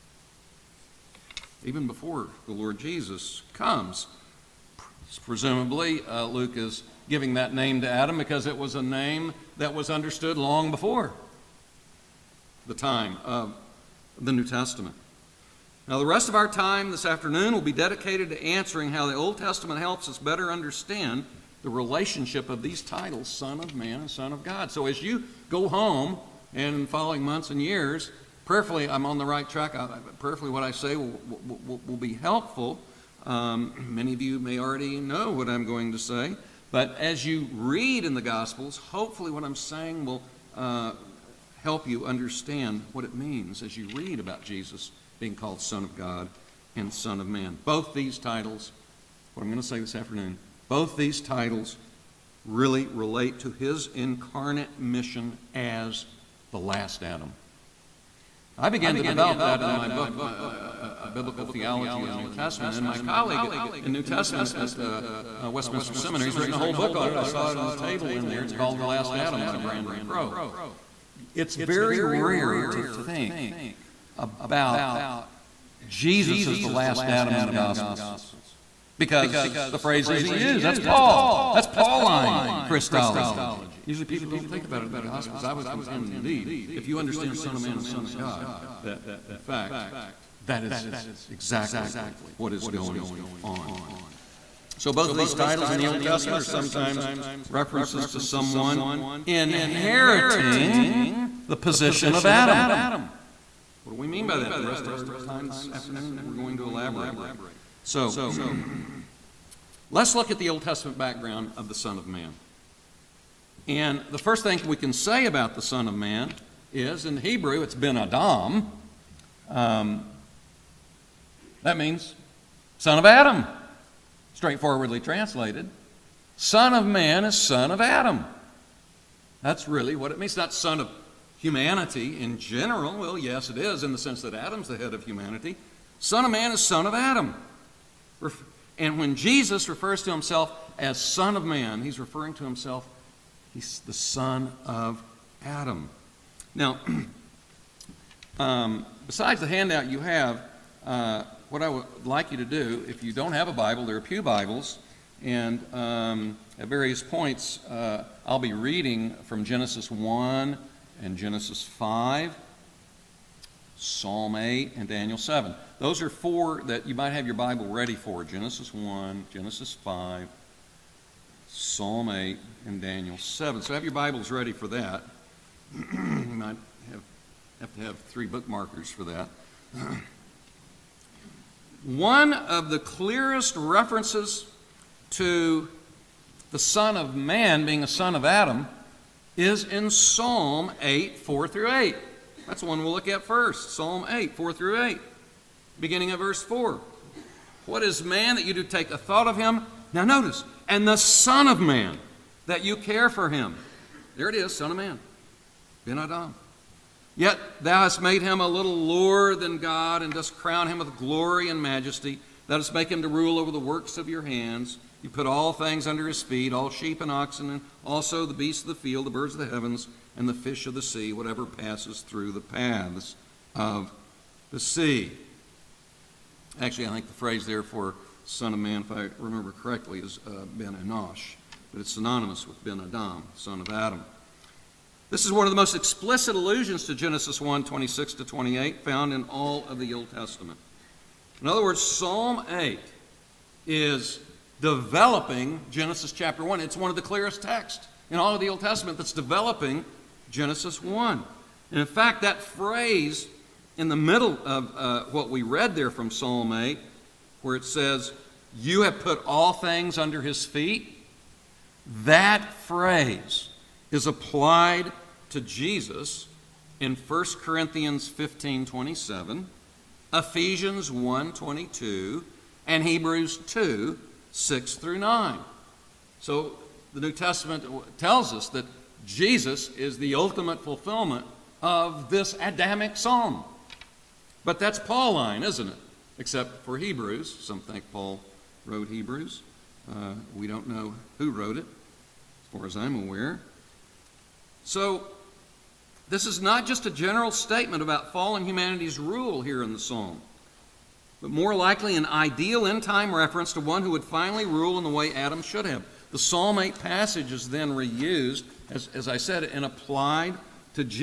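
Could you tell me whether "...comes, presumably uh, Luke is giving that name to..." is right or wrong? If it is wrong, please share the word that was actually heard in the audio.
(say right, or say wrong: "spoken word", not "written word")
right.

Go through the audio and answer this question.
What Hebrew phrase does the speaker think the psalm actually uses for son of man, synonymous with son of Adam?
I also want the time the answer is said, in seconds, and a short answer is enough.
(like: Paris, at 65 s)
Ben Enosh, at 230 s.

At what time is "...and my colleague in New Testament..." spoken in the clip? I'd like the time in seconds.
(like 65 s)
62 s.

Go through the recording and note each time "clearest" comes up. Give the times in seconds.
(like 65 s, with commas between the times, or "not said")
182 s, 247 s.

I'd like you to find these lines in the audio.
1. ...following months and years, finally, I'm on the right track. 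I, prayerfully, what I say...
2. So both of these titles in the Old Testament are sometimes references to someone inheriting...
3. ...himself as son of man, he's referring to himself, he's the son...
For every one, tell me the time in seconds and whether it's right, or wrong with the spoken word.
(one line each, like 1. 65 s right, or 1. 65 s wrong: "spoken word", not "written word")
1. 26 s wrong: "prayerfully", not "finally"
2. 94 s right
3. 140 s right.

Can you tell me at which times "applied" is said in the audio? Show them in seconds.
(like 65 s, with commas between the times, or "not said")
264 s, 309 s.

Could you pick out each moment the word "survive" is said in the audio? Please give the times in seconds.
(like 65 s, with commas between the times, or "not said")
not said.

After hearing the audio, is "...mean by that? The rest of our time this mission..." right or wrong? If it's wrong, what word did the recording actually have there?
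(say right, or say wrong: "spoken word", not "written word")
wrong: "afternoon", not "mission".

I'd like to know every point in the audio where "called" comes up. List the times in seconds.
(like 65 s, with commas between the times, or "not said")
45 s, 68 s.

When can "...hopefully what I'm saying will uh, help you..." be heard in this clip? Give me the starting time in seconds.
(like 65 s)
38 s.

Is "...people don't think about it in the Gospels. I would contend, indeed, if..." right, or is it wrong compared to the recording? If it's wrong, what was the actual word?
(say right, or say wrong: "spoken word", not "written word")
right.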